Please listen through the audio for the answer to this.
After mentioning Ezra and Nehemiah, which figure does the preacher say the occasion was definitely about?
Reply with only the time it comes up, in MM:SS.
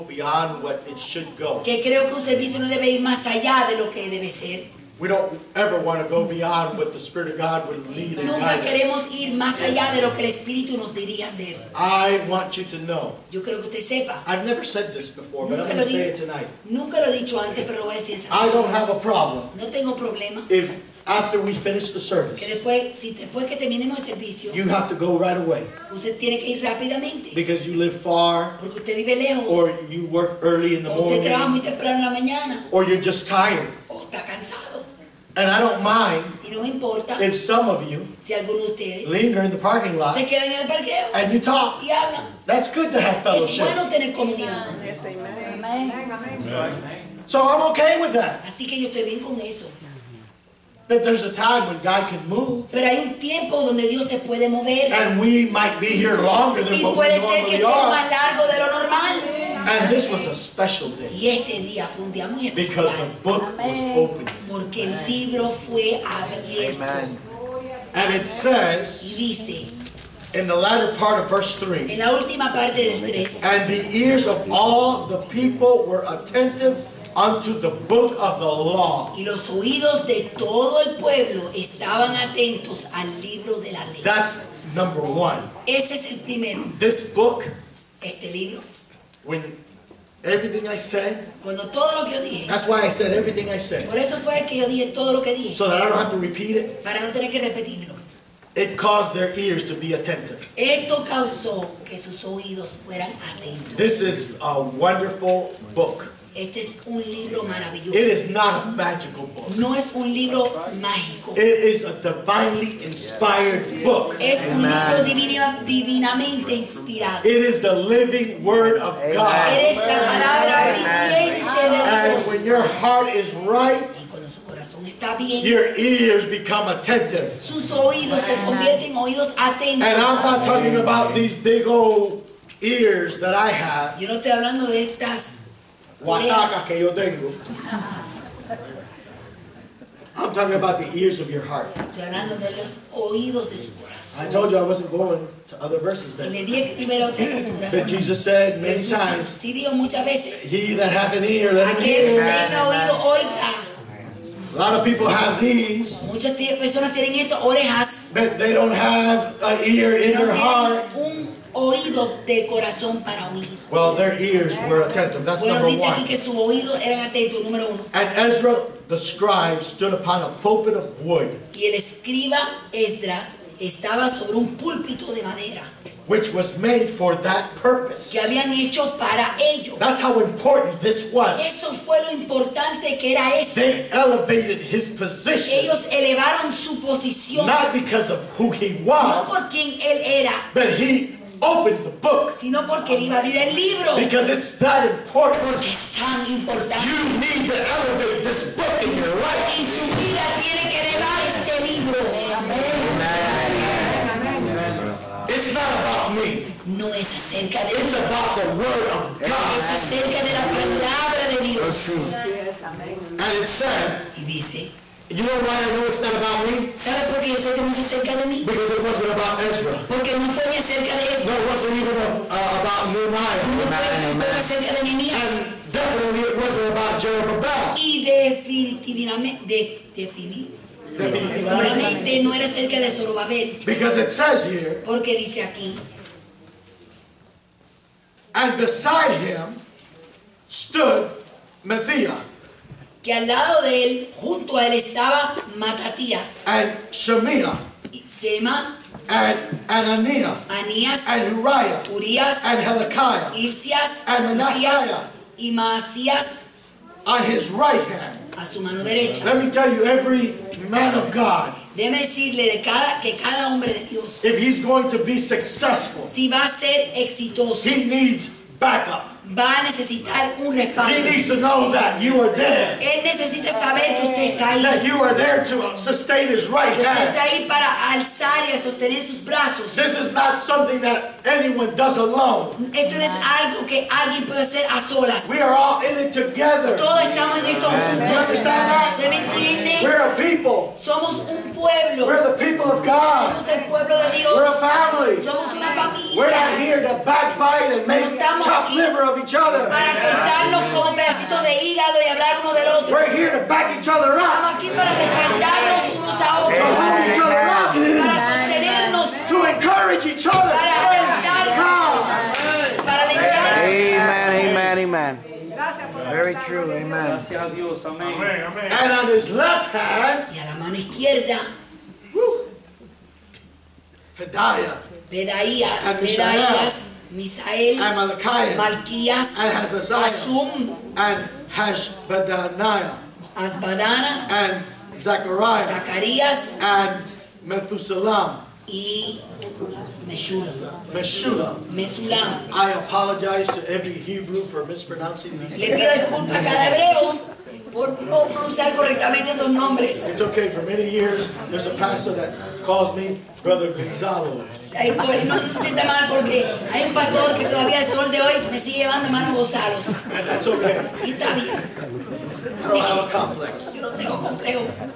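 03:46.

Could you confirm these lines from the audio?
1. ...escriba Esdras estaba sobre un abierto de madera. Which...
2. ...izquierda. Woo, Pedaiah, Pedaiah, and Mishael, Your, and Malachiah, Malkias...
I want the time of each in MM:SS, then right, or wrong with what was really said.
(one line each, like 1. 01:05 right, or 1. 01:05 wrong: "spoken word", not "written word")
1. 02:51 wrong: "púlpito", not "abierto"
2. 05:20 wrong: "Misael", not "Your".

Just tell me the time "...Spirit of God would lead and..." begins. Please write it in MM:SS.
00:06.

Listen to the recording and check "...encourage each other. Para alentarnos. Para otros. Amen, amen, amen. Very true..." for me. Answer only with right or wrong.
wrong.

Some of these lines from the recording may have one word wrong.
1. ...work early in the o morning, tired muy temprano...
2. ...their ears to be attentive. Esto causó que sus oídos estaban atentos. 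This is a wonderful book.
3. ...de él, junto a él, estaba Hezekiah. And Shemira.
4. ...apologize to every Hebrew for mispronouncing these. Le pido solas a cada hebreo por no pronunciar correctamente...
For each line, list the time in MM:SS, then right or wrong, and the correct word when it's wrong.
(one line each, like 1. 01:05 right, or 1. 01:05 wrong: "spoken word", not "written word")
1. 00:30 wrong: "usted", not "tired"
2. 01:39 wrong: "fueran", not "estaban"
3. 04:03 wrong: "Matatías", not "Hezekiah"
4. 05:42 wrong: "disculpas", not "solas".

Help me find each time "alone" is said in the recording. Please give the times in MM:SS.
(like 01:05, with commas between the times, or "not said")
04:41.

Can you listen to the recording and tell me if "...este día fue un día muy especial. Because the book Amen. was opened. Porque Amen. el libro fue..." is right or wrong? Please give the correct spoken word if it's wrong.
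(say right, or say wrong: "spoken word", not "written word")
right.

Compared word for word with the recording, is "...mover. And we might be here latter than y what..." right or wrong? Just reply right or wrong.
wrong.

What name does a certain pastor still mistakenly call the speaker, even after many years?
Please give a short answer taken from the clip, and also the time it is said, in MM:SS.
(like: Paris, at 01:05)
Brother Gonzalo, at 05:53.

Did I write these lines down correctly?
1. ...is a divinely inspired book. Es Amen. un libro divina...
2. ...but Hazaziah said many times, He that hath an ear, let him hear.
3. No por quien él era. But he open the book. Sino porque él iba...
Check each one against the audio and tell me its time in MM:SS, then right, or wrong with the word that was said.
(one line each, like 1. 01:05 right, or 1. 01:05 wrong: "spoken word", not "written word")
1. 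01:51 right
2. 02:27 wrong: "Jesus", not "Hazaziah"
3. 03:09 right.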